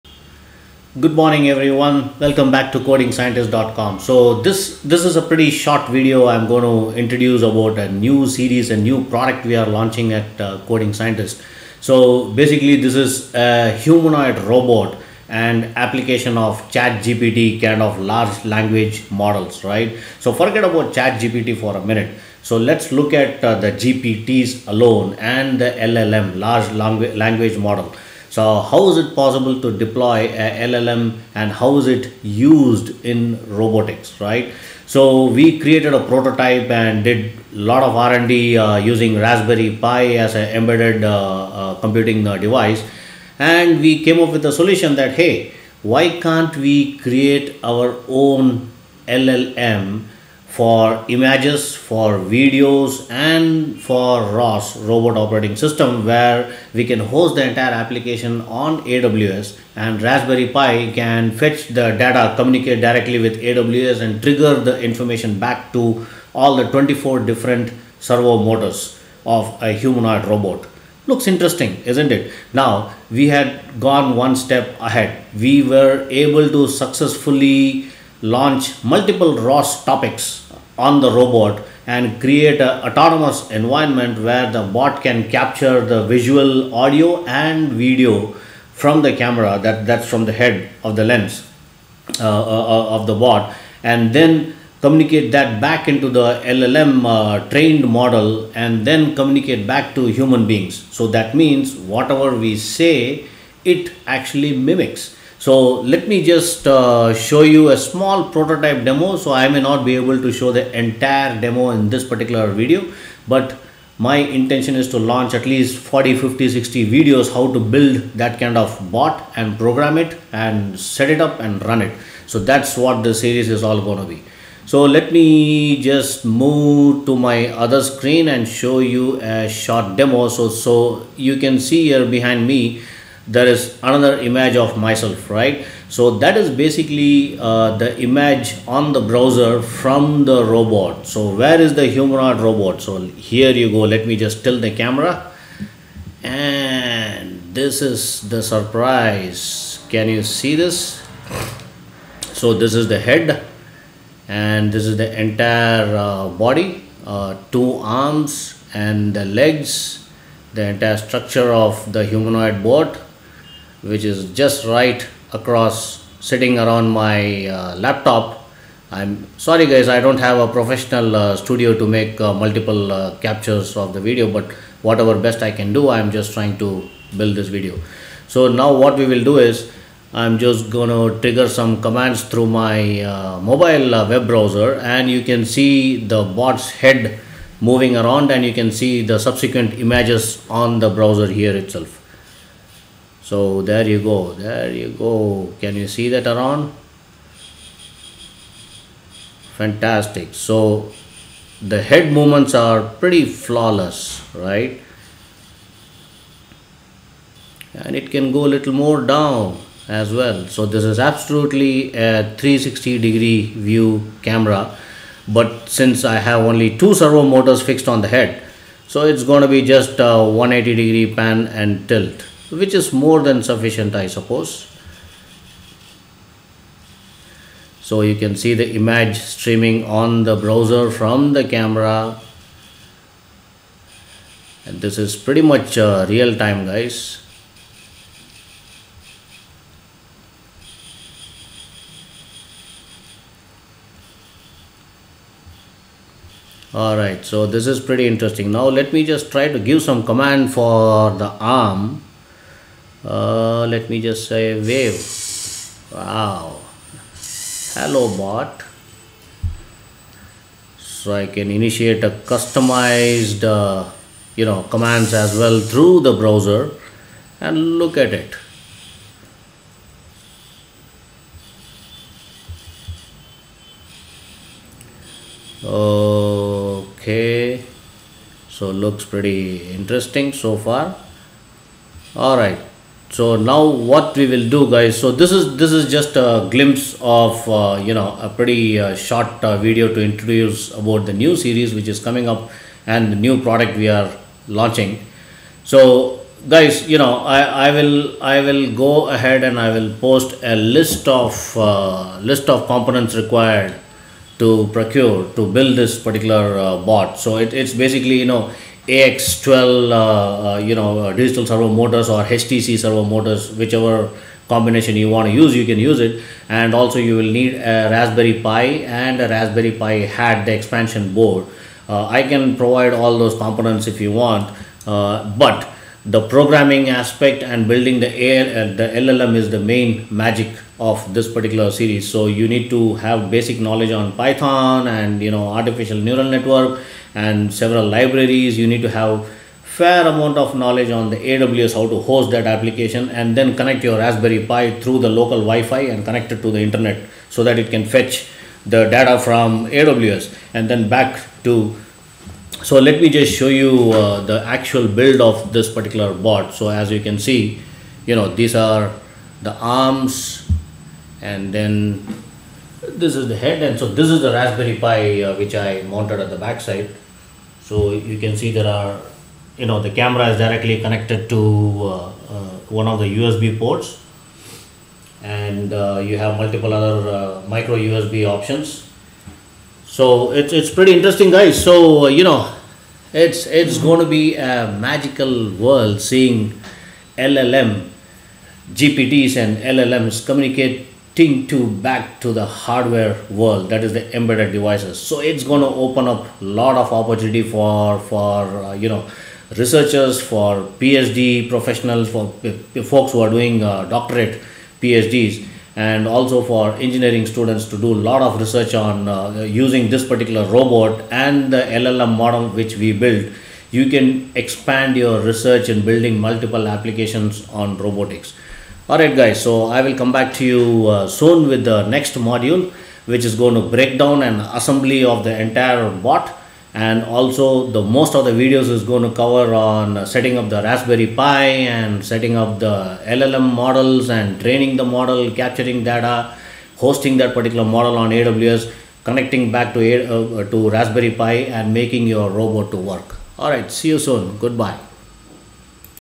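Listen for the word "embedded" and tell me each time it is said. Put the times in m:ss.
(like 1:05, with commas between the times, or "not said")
0:40, 6:34.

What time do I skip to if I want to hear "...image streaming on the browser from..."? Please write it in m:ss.
3:48.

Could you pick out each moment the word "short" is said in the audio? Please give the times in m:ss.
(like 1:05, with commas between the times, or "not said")
0:05, 2:09, 4:48.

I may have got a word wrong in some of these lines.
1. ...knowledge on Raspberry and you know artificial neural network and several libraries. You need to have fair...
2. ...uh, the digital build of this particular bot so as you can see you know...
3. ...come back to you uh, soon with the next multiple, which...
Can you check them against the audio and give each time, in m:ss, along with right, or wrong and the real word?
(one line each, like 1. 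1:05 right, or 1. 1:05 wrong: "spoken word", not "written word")
1. 5:33 wrong: "Python", not "Raspberry"
2. 5:53 wrong: "actual", not "digital"
3. 6:59 wrong: "module", not "multiple".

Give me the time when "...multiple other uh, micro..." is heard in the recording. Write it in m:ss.
6:16.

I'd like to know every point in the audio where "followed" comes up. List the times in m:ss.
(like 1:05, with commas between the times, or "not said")
not said.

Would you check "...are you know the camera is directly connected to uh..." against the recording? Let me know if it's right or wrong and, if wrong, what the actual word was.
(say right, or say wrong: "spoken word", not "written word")
right.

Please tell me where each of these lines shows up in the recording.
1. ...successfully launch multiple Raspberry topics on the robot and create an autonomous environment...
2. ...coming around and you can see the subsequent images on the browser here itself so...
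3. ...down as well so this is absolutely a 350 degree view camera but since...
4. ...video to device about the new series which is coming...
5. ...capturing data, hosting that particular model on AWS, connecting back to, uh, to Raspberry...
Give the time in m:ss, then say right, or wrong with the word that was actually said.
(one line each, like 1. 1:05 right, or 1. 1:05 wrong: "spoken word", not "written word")
1. 1:16 wrong: "ROS", not "Raspberry"
2. 3:07 wrong: "moving", not "coming"
3. 3:29 wrong: "360", not "350"
4. 4:49 wrong: "introduce", not "device"
5. 7:15 right.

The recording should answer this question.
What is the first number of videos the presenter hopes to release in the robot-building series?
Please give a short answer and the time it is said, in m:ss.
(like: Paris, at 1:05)
40, at 1:55.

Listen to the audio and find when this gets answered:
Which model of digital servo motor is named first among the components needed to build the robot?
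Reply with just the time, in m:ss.
5:08.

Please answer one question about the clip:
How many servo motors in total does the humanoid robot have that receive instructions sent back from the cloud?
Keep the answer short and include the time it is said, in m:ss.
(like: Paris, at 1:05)
24, at 1:06.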